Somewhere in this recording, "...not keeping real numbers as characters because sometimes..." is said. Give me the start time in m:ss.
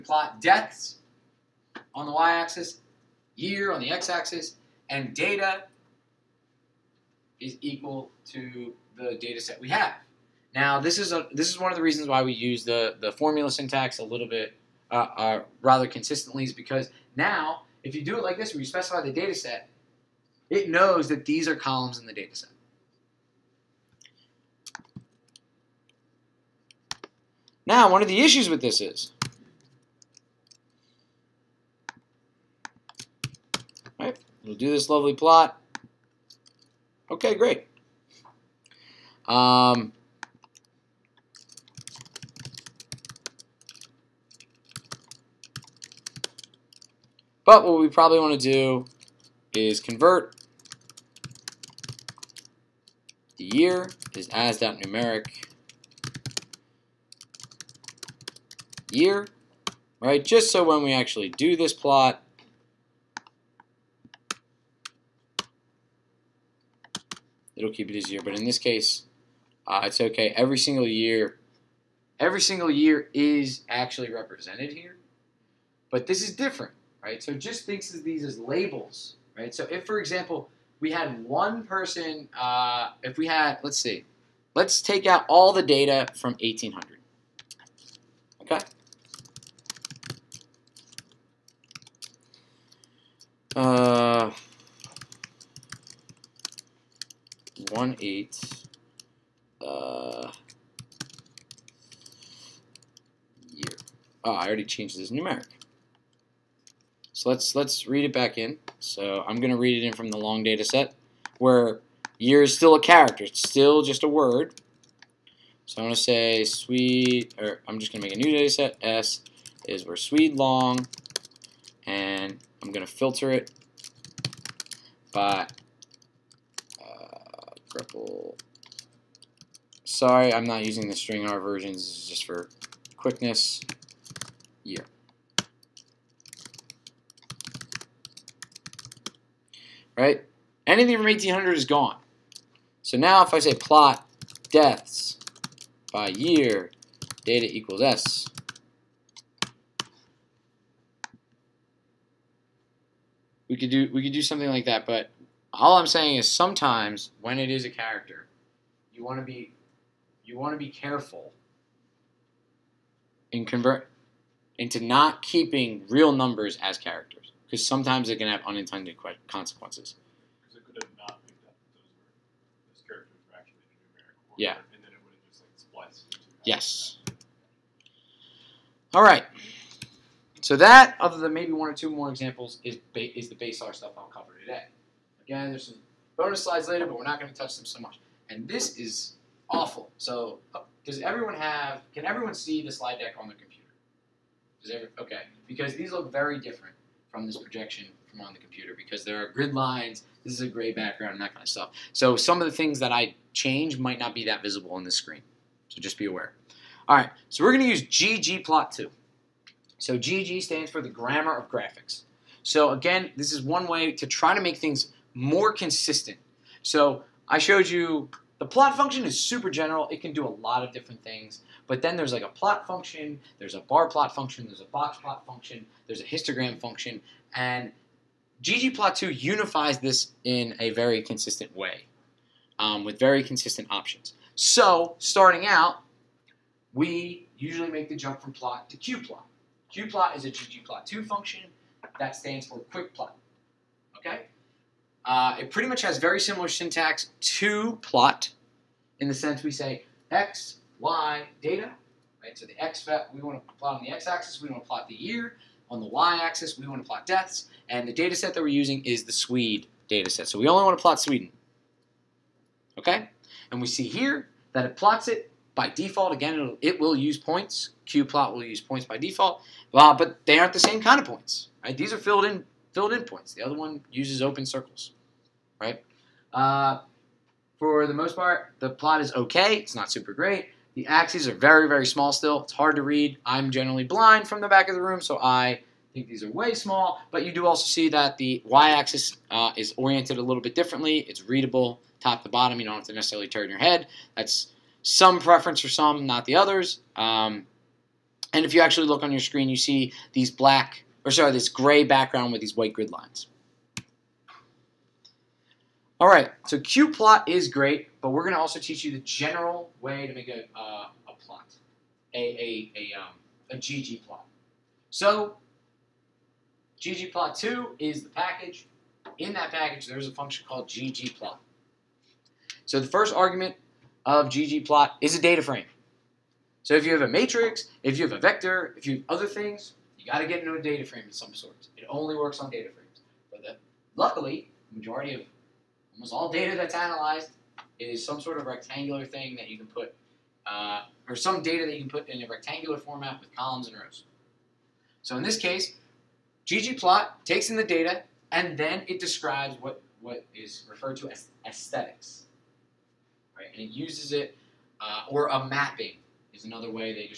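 2:44.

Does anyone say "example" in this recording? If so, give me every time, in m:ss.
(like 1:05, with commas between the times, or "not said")
1:19, 3:02.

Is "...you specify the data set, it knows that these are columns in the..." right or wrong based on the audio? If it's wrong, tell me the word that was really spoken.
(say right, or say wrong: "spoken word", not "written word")
right.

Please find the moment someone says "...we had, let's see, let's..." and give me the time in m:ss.
1:23.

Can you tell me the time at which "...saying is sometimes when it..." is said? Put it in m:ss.
2:35.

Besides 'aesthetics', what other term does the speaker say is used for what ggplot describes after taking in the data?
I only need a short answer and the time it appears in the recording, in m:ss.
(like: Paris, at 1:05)
mapping, at 5:55.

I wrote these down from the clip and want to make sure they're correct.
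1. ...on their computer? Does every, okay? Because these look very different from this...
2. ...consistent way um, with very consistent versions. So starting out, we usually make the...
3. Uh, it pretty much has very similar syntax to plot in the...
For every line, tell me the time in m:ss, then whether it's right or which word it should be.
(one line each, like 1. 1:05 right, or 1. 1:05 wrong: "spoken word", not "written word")
1. 3:13 right
2. 3:51 wrong: "options", not "versions"
3. 4:05 right.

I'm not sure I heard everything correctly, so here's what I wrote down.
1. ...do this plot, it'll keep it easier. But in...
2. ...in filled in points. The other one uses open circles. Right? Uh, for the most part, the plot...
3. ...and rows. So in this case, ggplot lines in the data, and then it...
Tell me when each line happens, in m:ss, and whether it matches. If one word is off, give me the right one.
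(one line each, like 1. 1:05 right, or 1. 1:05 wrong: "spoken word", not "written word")
1. 1:01 right
2. 4:32 right
3. 5:43 wrong: "takes", not "lines".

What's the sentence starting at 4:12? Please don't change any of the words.
So the x we want to plot on the x-axis, we want to plot the year.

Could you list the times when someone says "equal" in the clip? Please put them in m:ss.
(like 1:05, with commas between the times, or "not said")
0:07, 2:27.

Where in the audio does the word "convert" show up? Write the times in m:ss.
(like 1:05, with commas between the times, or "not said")
0:49, 2:43.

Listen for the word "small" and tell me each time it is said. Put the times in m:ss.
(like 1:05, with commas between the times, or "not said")
4:41, 4:46.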